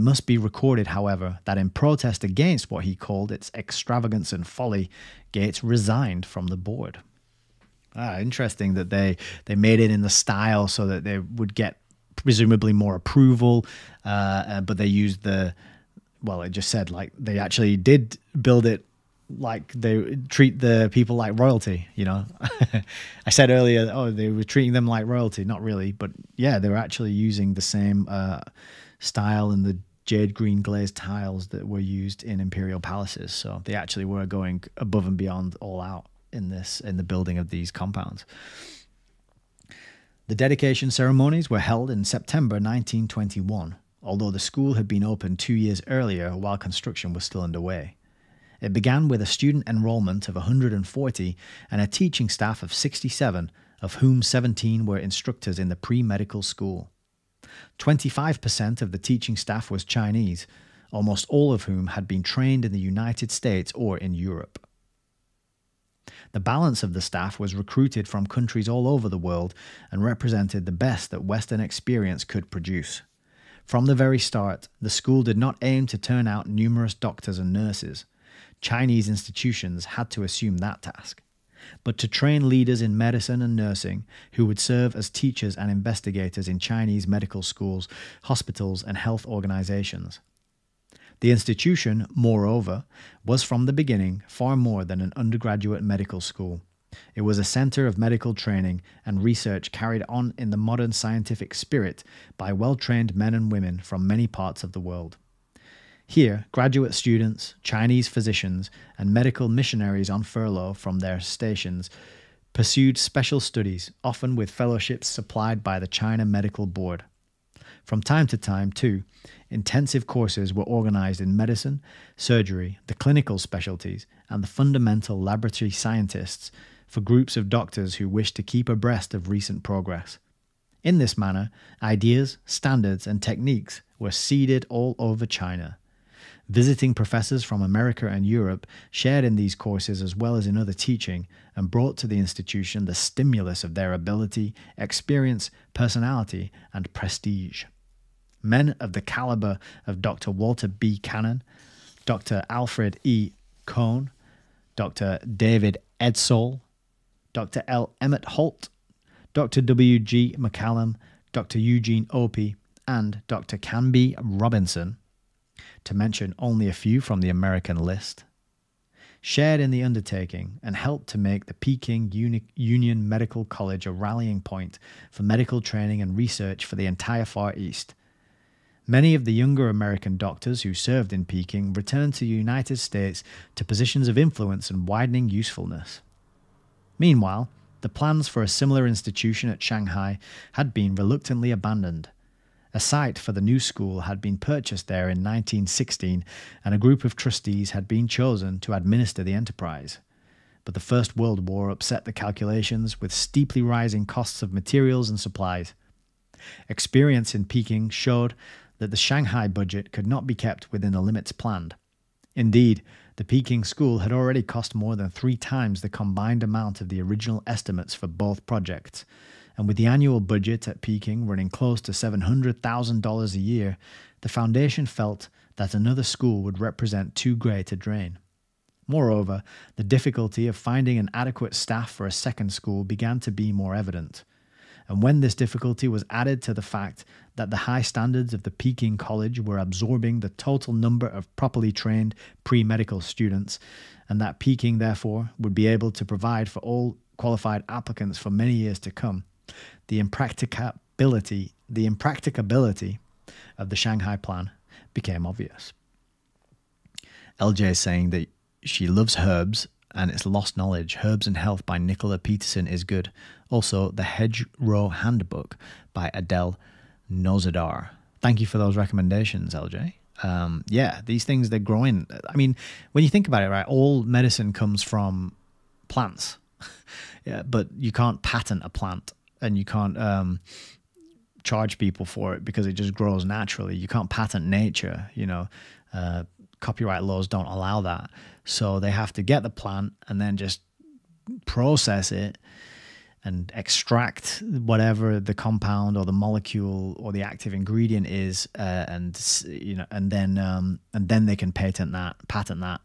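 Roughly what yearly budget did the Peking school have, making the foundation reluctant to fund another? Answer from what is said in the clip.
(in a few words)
$700,000.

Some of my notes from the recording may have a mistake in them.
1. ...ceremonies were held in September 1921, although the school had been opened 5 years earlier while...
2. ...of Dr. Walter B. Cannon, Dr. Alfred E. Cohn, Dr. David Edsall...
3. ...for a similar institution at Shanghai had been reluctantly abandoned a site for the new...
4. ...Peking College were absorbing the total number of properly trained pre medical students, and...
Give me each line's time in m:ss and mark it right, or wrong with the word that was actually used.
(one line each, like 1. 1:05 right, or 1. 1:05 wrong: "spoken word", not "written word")
1. 0:40 wrong: "2", not "5"
2. 2:29 right
3. 3:08 right
4. 3:58 right.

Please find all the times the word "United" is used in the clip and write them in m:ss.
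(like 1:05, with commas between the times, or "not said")
1:02, 3:02.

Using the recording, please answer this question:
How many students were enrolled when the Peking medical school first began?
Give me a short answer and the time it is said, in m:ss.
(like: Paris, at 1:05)
140, at 0:50.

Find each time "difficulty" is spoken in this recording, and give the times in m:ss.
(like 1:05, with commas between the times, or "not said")
3:49, 3:55.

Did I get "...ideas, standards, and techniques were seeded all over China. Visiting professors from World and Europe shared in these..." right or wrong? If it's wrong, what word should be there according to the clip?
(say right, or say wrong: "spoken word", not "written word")
wrong: "America", not "World".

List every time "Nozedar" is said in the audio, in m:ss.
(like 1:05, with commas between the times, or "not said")
4:27.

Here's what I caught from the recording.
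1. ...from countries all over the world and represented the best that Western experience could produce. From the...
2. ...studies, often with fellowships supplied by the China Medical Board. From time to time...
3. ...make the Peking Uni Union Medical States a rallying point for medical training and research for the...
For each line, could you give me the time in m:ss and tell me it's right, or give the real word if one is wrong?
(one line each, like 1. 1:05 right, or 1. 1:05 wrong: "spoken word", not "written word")
1. 1:08 right
2. 1:53 right
3. 2:51 wrong: "College", not "States".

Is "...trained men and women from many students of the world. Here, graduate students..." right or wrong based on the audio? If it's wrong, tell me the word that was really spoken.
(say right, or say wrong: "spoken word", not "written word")
wrong: "parts", not "students".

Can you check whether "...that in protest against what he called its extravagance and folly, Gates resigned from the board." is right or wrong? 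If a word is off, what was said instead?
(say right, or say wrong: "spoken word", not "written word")
right.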